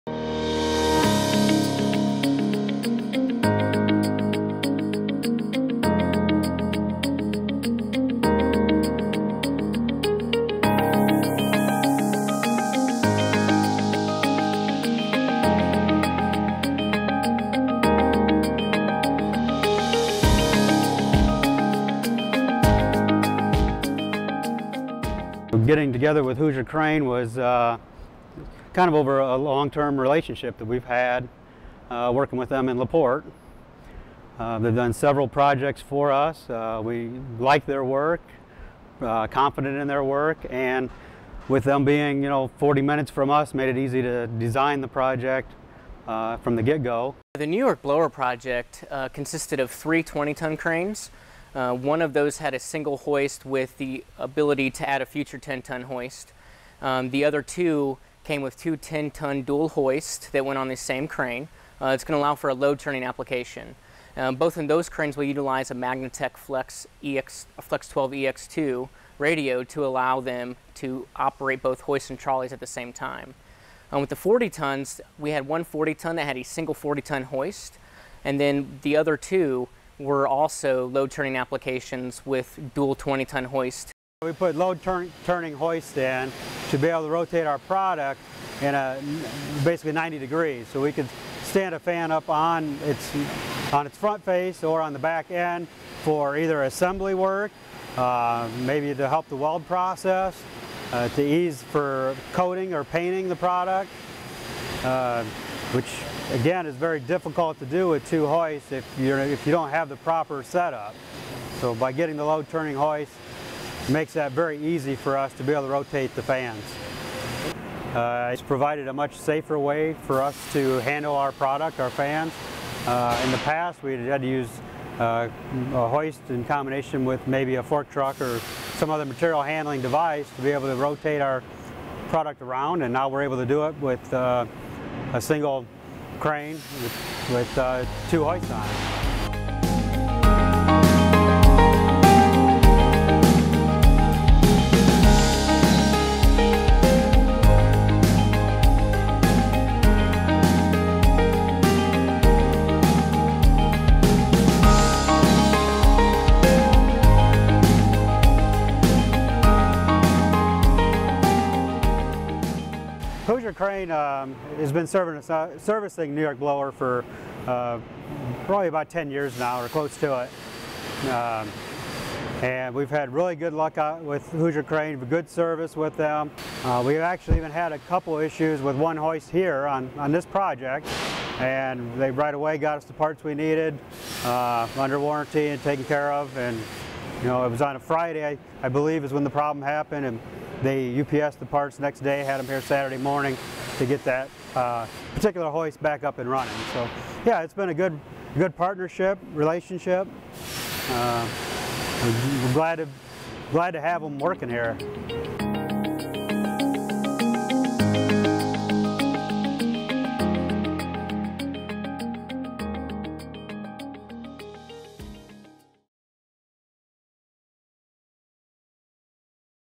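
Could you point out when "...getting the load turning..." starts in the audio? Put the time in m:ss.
1:51.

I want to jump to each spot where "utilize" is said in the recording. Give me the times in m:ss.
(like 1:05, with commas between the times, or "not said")
1:05.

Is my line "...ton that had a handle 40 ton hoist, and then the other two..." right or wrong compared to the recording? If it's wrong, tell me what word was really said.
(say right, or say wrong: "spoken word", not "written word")
wrong: "single", not "handle".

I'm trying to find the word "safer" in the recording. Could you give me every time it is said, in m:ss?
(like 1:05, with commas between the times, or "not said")
1:59.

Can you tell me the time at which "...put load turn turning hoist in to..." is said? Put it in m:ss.
1:24.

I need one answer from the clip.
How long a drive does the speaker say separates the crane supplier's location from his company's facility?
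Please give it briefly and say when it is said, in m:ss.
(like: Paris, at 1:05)
40 minutes, at 0:42.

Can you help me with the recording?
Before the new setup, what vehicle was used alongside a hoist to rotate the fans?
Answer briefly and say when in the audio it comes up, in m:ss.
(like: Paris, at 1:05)
fork truck, at 2:07.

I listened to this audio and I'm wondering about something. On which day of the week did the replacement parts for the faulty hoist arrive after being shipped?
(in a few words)
Saturday.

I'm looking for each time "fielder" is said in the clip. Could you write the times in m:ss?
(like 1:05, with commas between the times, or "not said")
not said.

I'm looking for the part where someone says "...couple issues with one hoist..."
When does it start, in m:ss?
2:57.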